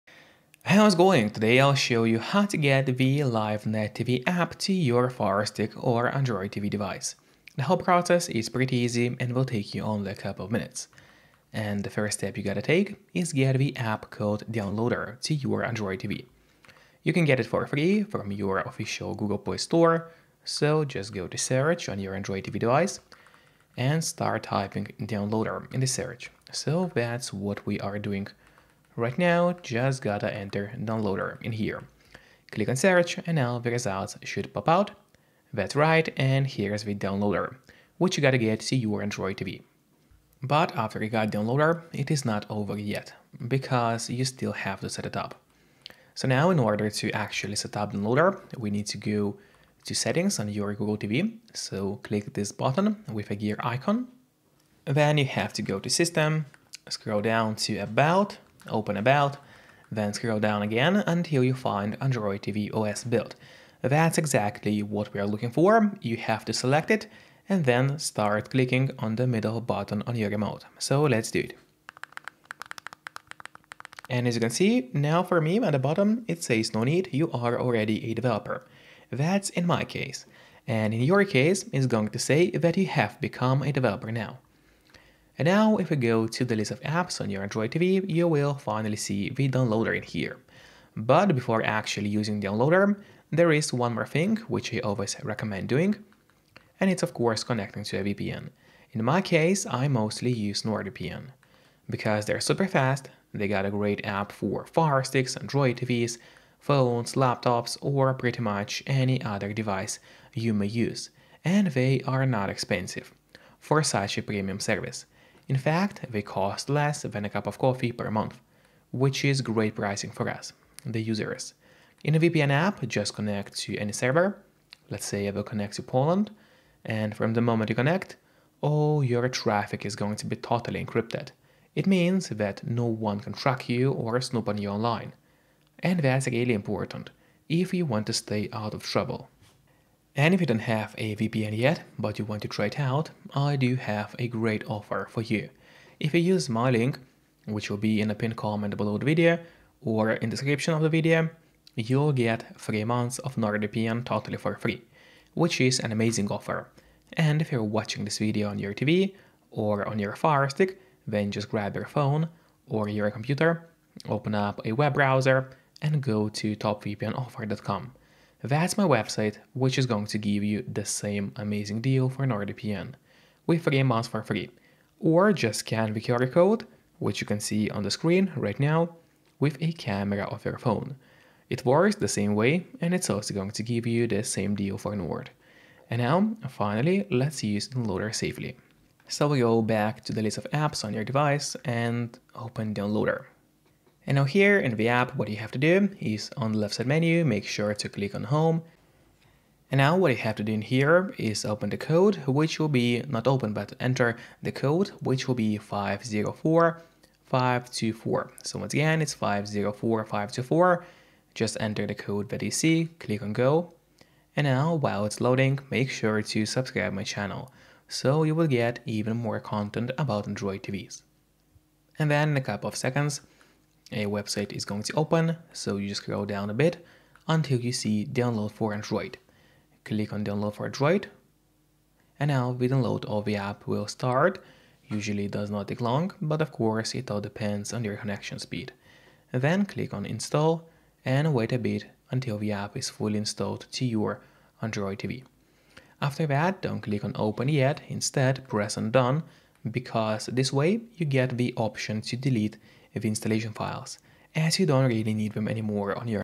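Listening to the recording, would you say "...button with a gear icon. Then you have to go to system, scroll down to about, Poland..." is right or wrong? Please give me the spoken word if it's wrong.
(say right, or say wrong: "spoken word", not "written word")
wrong: "Open", not "Poland".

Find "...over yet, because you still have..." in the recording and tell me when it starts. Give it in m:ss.
0:42.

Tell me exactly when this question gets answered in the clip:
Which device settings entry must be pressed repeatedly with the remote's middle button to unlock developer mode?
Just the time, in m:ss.
1:02.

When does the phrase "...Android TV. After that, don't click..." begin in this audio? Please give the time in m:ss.
4:04.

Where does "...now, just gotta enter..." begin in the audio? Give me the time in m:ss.
0:29.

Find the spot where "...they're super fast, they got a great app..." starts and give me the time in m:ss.
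1:42.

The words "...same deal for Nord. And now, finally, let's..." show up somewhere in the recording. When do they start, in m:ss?
3:04.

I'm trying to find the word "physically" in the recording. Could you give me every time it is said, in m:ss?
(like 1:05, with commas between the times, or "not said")
not said.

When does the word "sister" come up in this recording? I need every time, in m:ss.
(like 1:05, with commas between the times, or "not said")
not said.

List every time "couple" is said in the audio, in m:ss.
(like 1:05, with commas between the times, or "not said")
0:10, 3:42.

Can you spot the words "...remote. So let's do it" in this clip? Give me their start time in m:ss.
1:10.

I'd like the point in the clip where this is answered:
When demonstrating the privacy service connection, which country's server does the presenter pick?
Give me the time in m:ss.
2:05.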